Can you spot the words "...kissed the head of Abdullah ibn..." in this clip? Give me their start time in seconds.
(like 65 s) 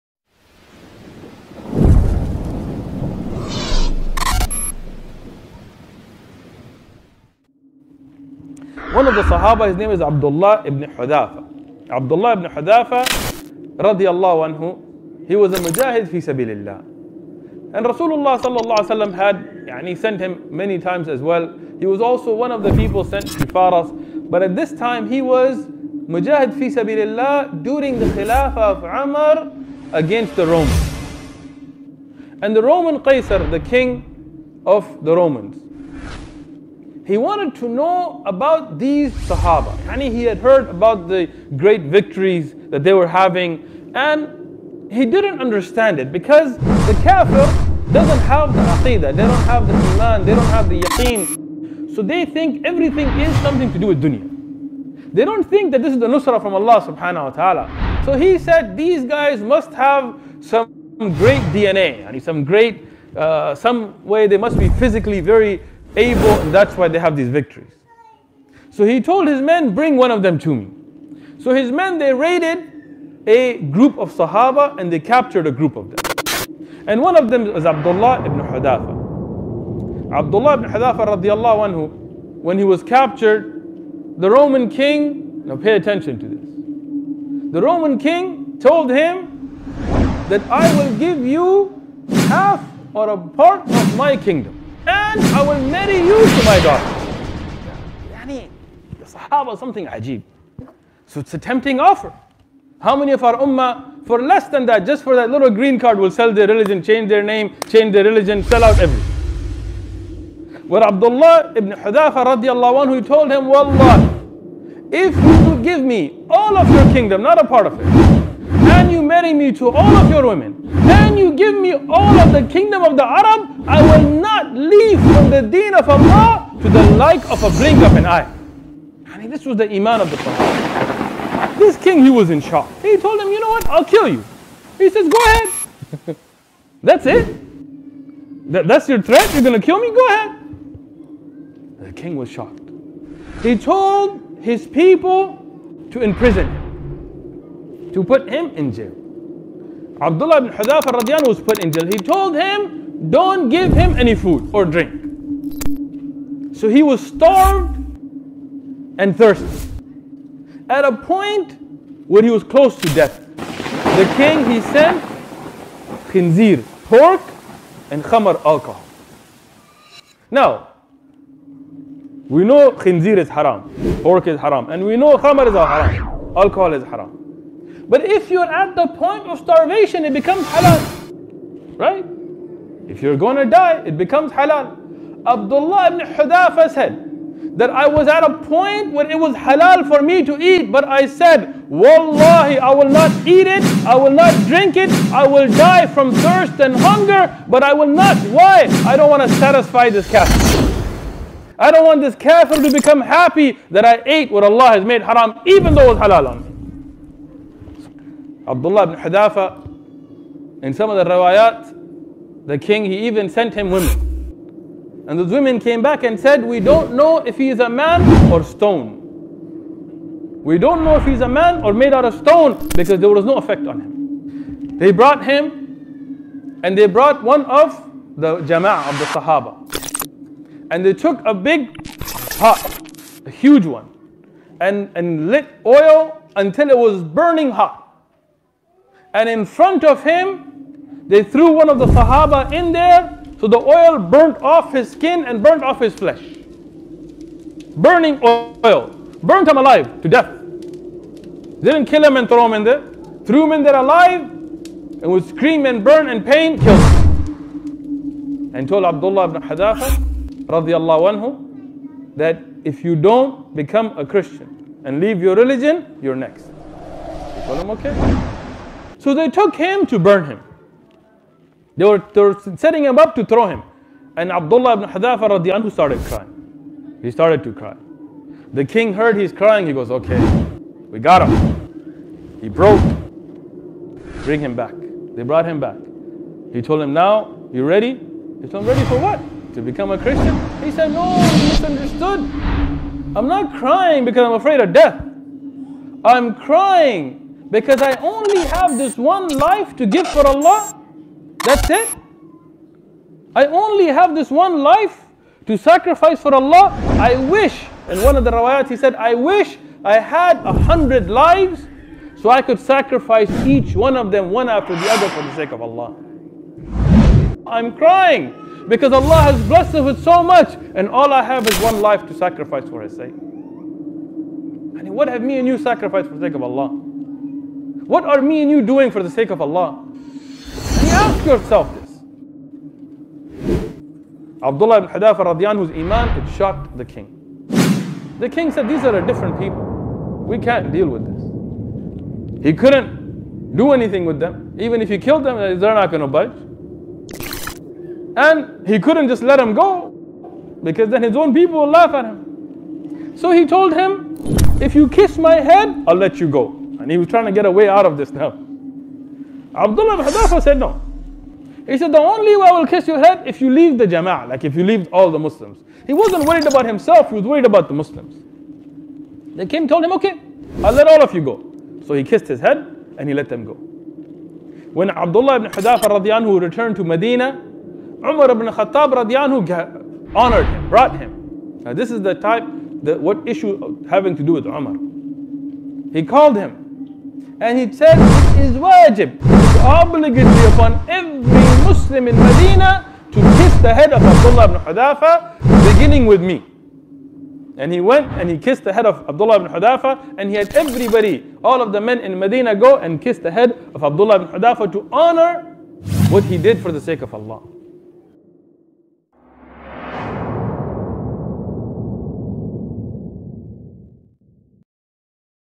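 398 s.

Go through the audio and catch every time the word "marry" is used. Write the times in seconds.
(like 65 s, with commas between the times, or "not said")
95 s, 119 s.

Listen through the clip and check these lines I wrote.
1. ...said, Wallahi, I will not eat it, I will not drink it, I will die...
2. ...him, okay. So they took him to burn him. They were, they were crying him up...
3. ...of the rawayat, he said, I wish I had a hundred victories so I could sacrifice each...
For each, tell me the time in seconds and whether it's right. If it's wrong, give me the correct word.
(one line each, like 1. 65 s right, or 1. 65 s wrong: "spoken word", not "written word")
1. 191 s right
2. 267 s wrong: "setting", not "crying"
3. 308 s wrong: "lives", not "victories".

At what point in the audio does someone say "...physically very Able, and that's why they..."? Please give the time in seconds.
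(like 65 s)
64 s.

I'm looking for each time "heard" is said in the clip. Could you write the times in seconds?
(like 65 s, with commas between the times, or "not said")
40 s, 278 s.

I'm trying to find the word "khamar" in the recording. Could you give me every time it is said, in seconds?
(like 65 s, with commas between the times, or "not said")
168 s, 175 s.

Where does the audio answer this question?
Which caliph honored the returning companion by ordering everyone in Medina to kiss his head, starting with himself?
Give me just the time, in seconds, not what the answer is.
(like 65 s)
377 s.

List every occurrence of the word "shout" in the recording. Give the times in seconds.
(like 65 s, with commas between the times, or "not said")
not said.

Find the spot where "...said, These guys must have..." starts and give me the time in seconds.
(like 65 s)
58 s.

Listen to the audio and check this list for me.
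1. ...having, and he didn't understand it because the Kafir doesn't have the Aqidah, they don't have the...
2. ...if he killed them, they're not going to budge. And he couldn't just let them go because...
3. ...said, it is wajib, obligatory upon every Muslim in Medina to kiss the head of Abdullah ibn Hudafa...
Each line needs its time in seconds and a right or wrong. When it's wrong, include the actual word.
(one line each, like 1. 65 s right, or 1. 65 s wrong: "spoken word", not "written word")
1. 43 s right
2. 344 s right
3. 387 s right.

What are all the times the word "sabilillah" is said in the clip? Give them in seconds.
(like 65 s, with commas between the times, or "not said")
16 s, 26 s.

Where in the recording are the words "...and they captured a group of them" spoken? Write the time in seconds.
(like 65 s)
74 s.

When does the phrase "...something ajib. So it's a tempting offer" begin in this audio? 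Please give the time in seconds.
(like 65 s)
99 s.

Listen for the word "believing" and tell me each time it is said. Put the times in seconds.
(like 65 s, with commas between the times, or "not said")
not said.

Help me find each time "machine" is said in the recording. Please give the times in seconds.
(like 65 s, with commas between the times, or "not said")
not said.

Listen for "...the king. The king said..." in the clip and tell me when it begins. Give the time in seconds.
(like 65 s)
336 s.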